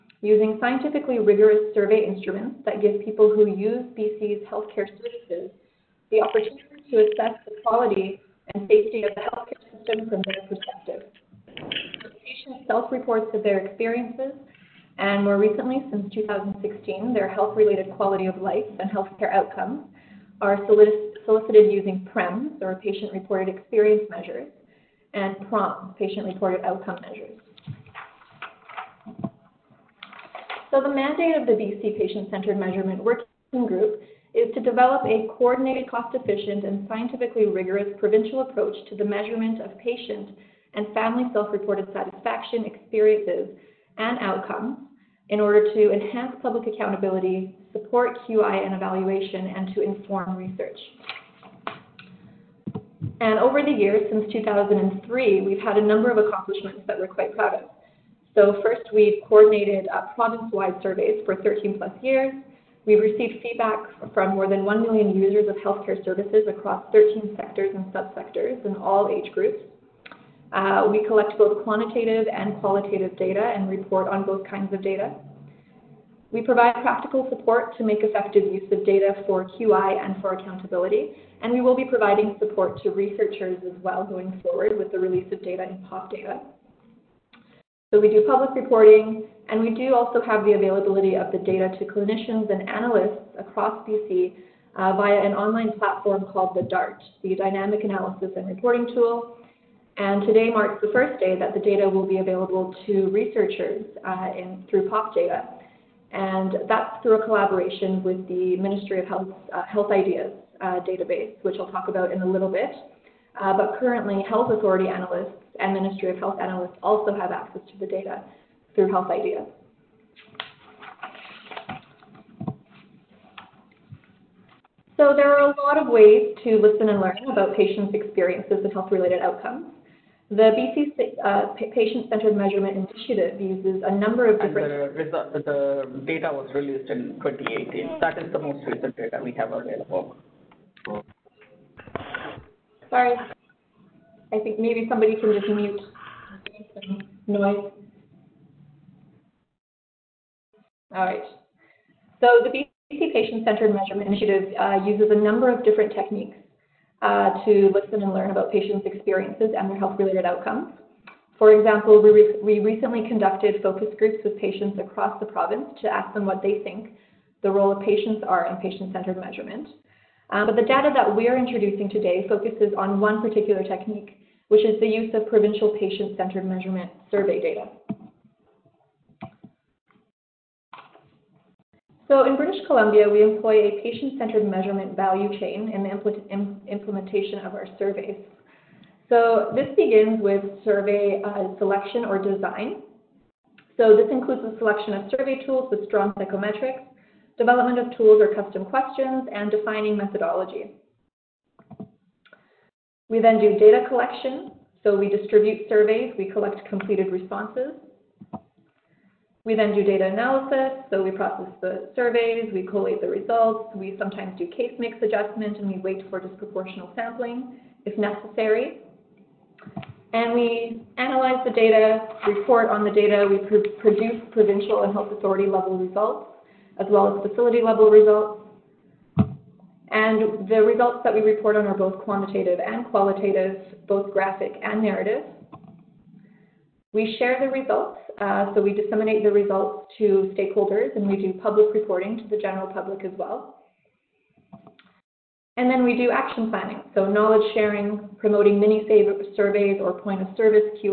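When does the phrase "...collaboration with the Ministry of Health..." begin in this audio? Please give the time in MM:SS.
01:47.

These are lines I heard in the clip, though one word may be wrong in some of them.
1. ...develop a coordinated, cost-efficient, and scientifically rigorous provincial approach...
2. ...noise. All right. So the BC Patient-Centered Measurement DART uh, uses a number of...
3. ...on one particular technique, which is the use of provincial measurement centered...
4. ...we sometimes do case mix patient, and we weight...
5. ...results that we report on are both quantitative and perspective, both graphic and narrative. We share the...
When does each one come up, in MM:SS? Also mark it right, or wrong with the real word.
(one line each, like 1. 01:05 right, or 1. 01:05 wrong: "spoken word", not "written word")
1. 00:34 right
2. 02:27 wrong: "Initiative", not "DART"
3. 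02:52 wrong: "patient", not "measurement"
4. 03:33 wrong: "adjustment", not "patient"
5. 03:50 wrong: "qualitative", not "perspective".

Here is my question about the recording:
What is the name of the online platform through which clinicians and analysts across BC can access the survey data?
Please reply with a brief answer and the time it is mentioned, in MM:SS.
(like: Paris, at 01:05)
DART, at 01:36.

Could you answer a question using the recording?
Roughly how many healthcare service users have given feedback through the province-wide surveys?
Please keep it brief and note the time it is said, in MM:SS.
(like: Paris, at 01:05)
more than 1 million, at 01:04.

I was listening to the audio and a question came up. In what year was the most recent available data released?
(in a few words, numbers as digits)
2018.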